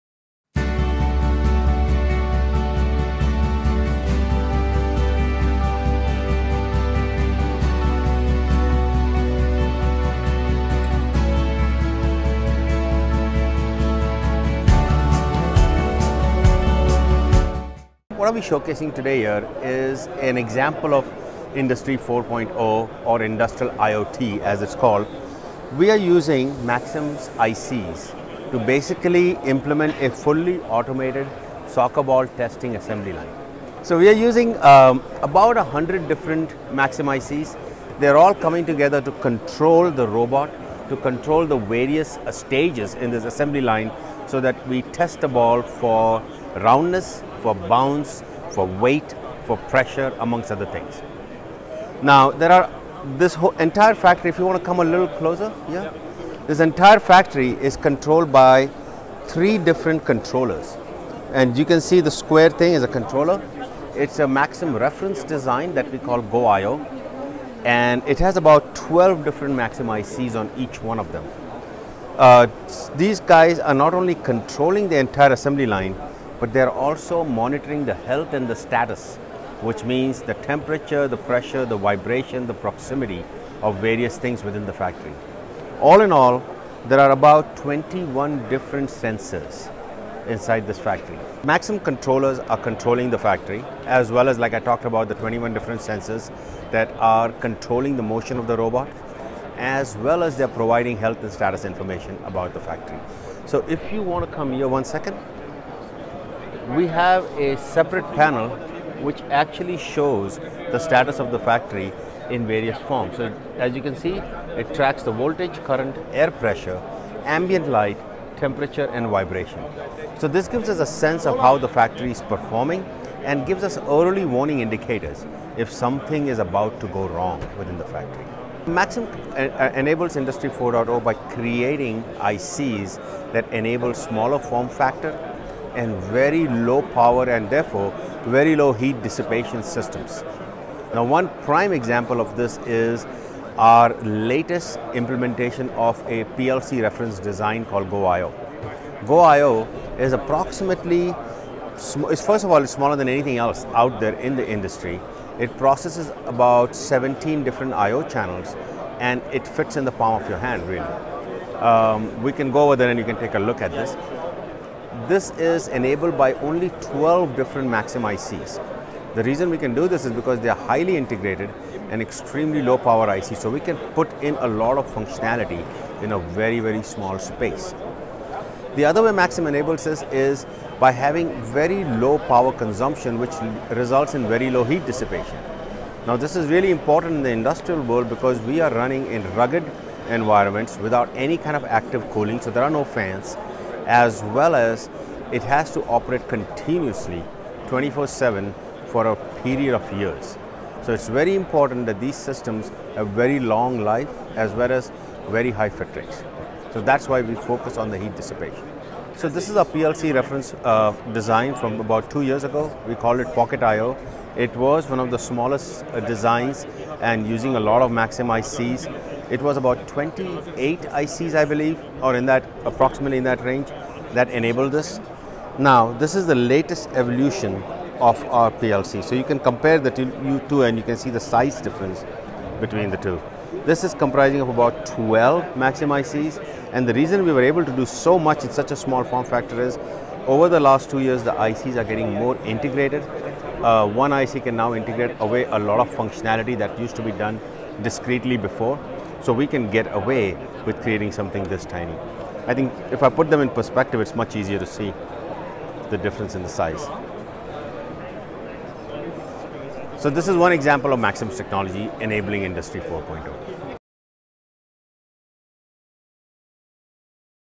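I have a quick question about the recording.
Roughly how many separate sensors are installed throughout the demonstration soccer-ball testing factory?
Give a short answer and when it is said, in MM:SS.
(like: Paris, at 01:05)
21, at 01:27.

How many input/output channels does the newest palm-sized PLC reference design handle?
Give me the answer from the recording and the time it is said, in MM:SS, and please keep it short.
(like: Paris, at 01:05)
17, at 02:36.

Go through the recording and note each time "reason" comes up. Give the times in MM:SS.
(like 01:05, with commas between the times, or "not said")
02:49, 03:56.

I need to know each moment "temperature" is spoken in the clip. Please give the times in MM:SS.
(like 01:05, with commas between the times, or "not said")
01:20, 01:58.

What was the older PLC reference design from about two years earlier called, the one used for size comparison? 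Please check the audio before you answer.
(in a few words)
Pocket I.O.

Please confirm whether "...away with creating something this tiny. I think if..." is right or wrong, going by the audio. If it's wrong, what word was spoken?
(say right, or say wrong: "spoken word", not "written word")
right.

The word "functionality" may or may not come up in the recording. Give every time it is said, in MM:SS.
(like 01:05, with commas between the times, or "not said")
02:54, 04:05.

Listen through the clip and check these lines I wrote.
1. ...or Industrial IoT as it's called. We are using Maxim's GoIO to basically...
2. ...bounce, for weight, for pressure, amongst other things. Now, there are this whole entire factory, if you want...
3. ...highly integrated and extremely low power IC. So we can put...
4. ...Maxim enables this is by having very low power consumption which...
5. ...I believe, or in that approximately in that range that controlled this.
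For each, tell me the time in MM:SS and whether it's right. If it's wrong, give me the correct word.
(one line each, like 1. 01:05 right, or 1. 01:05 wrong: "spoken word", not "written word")
1. 00:23 wrong: "ICs", not "GoIO"
2. 00:47 right
3. 02:50 right
4. 02:59 right
5. 03:41 wrong: "enabled", not "controlled".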